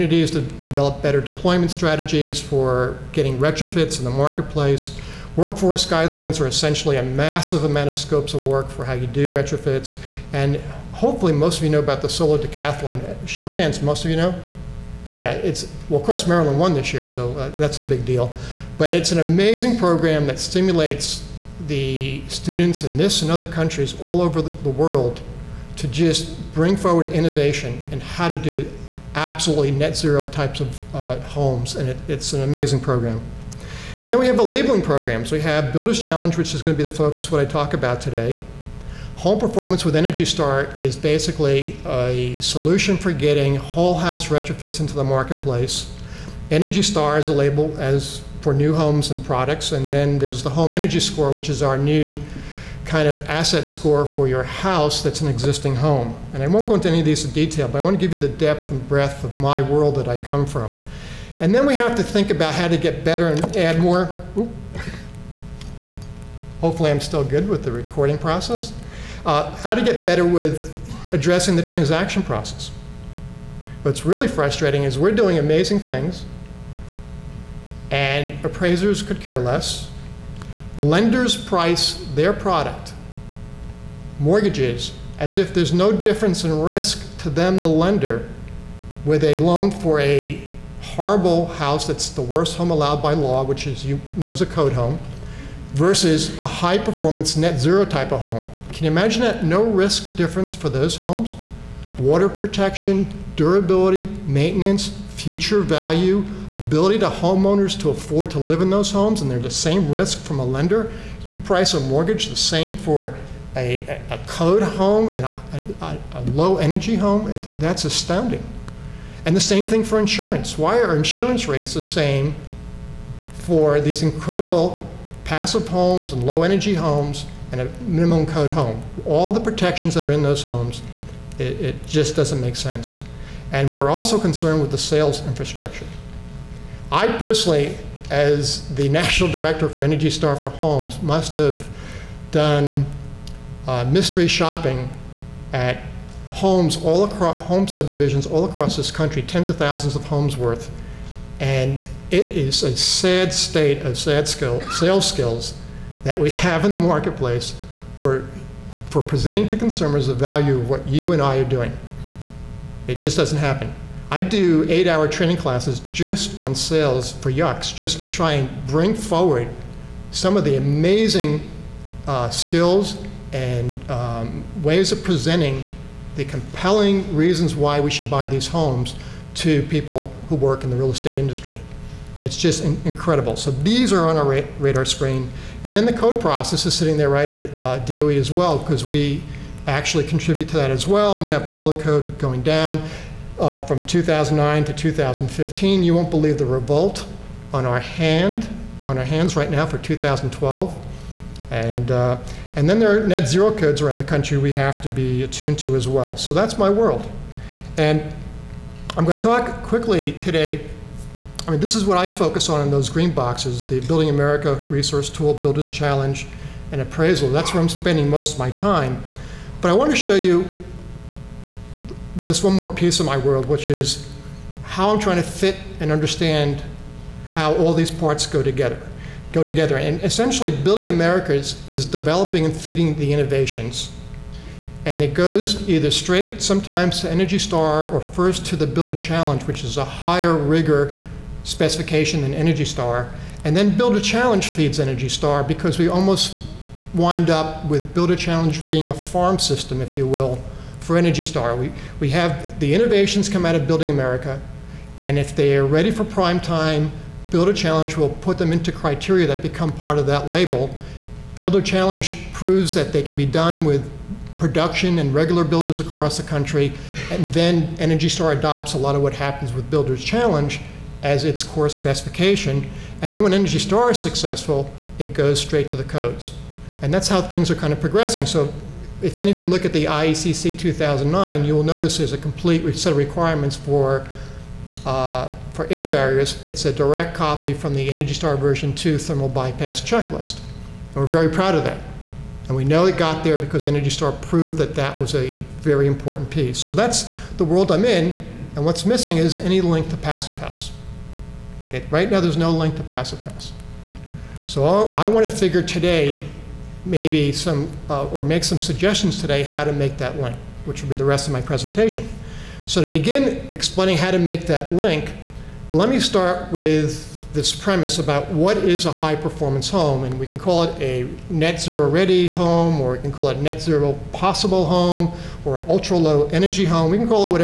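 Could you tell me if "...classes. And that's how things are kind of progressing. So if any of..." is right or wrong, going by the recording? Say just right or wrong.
wrong.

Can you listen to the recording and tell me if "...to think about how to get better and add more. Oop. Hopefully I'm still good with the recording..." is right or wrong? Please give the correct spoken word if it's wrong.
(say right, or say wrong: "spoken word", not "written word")
right.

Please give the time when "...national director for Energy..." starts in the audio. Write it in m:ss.
2:18.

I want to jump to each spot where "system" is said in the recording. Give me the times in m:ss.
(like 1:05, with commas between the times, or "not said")
4:09.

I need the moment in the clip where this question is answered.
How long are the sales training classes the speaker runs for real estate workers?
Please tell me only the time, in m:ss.
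2:44.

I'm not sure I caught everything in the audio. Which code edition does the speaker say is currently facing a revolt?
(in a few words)
2012.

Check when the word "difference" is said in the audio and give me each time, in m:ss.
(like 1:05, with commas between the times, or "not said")
1:25, 1:40.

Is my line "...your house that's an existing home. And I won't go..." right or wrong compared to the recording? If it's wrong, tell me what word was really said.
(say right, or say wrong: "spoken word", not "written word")
right.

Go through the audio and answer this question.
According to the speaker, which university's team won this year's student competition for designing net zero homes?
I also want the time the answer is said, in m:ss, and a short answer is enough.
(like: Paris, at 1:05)
Maryland, at 0:16.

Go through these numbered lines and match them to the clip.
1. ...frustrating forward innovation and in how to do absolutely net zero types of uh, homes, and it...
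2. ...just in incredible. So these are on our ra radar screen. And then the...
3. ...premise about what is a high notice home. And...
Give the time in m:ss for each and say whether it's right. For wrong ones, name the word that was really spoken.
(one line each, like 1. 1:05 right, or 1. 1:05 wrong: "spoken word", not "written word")
1. 0:26 wrong: "bring", not "frustrating"
2. 3:02 right
3. 5:17 wrong: "performance", not "notice".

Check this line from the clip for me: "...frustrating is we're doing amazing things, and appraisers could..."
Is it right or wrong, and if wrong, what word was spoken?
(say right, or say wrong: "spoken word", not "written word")
right.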